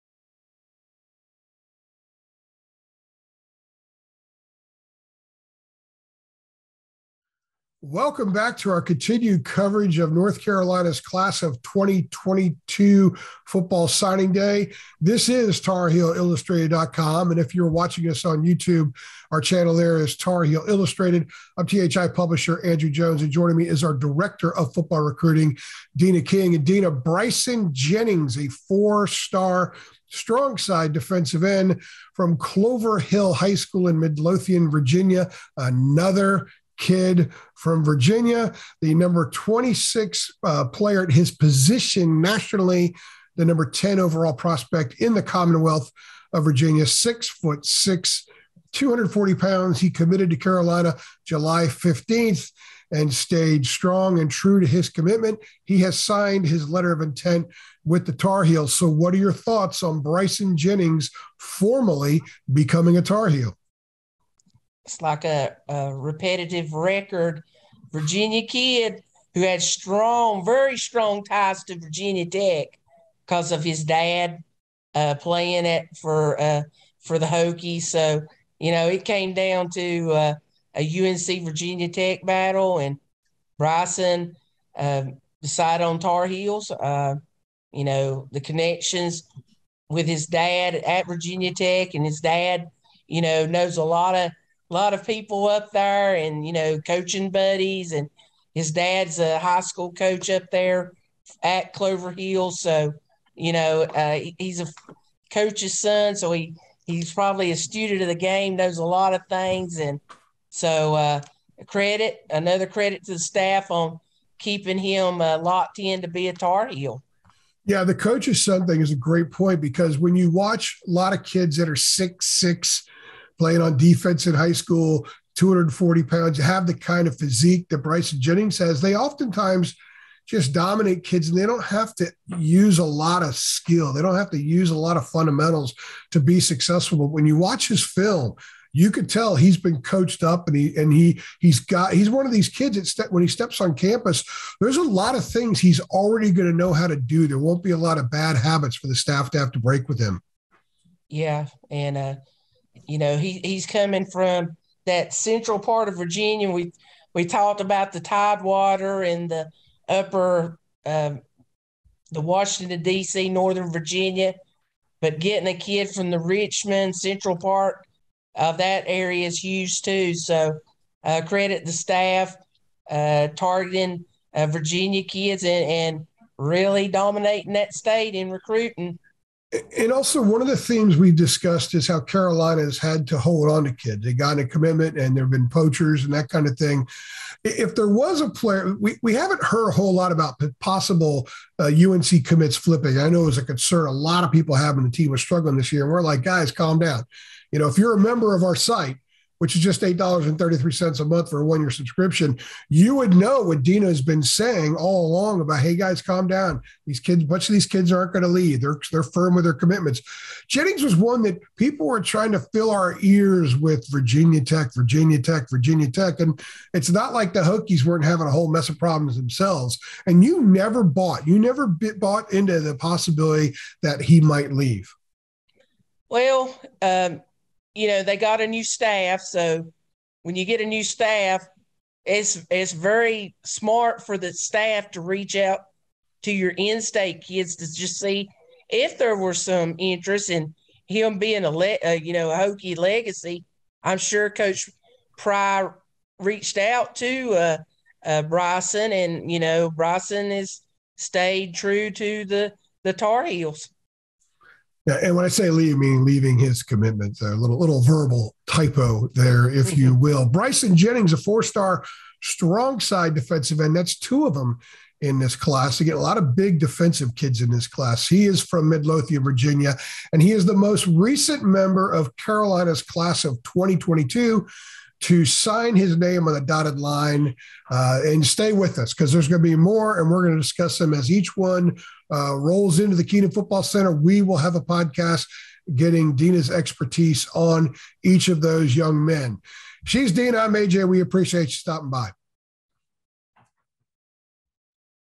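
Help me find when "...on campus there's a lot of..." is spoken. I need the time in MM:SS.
02:23.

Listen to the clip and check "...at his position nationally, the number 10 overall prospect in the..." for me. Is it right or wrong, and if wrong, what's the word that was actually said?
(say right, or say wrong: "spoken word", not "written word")
right.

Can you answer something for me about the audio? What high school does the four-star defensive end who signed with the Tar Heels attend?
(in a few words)
Clover Hill High School.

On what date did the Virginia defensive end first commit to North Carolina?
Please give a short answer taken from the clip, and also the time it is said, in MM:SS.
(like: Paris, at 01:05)
July 15th, at 00:51.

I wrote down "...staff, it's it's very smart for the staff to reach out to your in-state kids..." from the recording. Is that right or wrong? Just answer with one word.
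right.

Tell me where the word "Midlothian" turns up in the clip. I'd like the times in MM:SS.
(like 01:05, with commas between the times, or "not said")
00:33, 04:28.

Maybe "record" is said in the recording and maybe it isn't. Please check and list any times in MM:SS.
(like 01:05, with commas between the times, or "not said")
01:06.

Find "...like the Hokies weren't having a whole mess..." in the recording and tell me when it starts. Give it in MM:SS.
03:37.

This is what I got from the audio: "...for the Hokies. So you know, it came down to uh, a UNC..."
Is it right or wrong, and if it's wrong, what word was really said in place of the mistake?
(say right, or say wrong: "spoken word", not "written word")
right.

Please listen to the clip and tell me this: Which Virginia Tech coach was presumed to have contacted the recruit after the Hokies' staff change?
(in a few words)
Coach Pry.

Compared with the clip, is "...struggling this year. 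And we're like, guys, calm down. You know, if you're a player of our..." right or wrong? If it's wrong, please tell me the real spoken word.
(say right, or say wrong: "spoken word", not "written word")
wrong: "member", not "player".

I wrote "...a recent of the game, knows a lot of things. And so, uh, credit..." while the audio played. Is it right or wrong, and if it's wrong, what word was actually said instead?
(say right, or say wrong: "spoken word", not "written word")
wrong: "student", not "recent".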